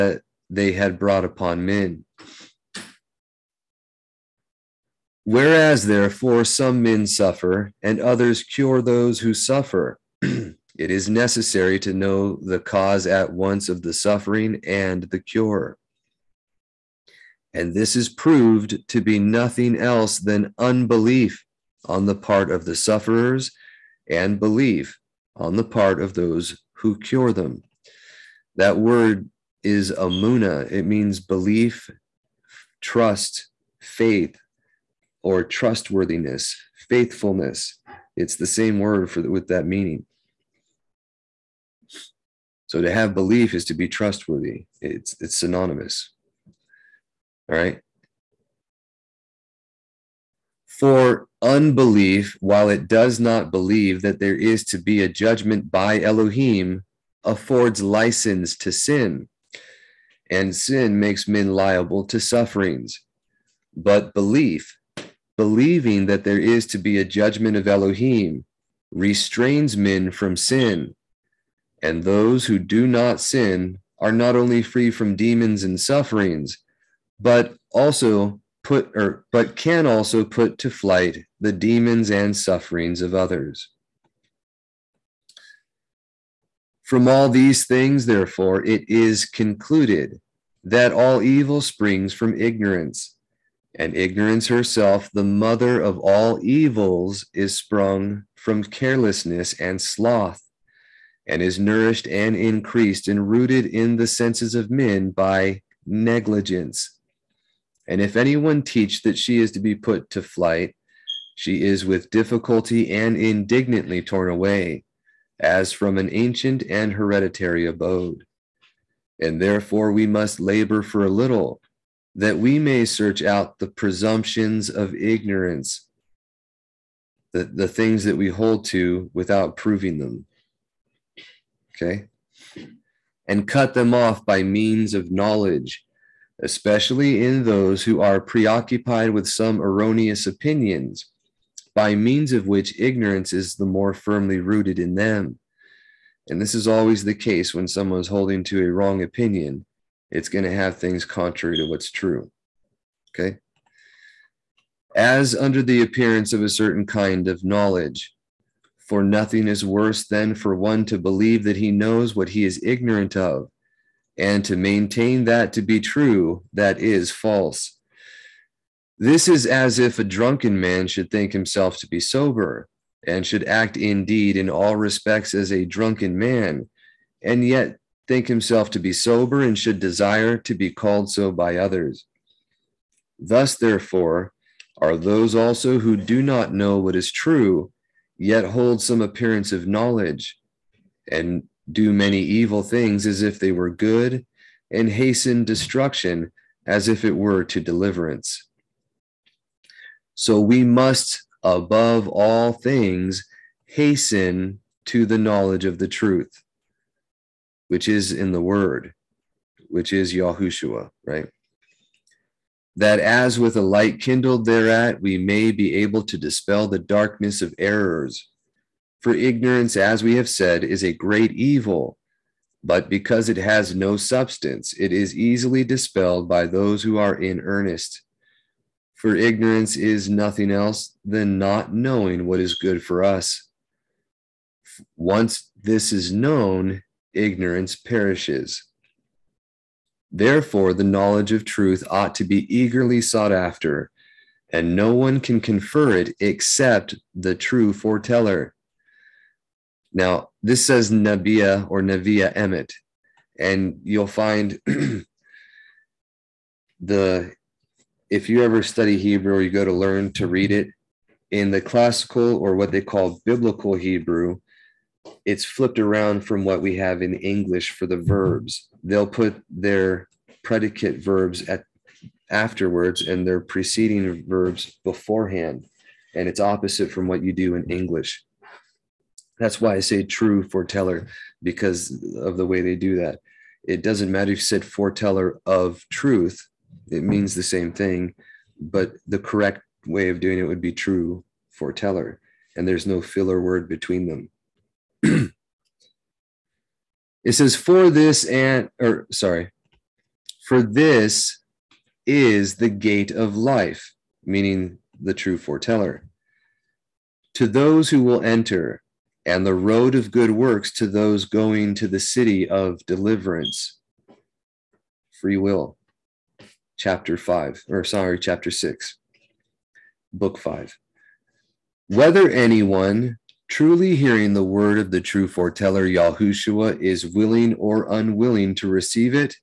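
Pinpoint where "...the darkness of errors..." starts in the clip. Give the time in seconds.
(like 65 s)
216 s.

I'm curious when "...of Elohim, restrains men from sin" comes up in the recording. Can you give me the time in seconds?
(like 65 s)
67 s.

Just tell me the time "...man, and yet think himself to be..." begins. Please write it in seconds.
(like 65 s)
176 s.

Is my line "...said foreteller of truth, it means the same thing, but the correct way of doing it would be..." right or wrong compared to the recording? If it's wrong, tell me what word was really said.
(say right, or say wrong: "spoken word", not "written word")
right.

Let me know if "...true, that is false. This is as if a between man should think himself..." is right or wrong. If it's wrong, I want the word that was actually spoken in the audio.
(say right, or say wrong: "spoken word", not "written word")
wrong: "drunken", not "between".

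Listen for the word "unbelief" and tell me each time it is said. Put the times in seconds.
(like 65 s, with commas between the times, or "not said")
20 s, 51 s.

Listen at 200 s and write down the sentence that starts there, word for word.
So we must, above all things, hasten to the knowledge of the truth, which is in the Word, which is Yahushua, right?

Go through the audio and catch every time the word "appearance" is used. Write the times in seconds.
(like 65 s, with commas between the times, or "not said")
155 s, 189 s.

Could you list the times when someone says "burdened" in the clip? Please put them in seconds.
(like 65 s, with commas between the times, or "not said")
not said.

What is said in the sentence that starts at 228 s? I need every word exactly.
For ignorance is nothing else than not knowing what is good for us.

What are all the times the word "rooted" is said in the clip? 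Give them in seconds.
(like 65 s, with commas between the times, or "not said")
103 s, 144 s.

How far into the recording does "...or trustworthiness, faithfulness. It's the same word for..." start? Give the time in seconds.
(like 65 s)
35 s.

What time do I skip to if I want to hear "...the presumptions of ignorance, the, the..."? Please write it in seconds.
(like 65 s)
123 s.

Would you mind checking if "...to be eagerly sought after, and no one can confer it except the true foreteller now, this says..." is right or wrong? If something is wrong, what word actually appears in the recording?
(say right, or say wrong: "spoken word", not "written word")
right.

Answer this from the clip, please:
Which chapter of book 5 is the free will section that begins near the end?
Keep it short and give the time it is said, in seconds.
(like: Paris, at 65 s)
6, at 318 s.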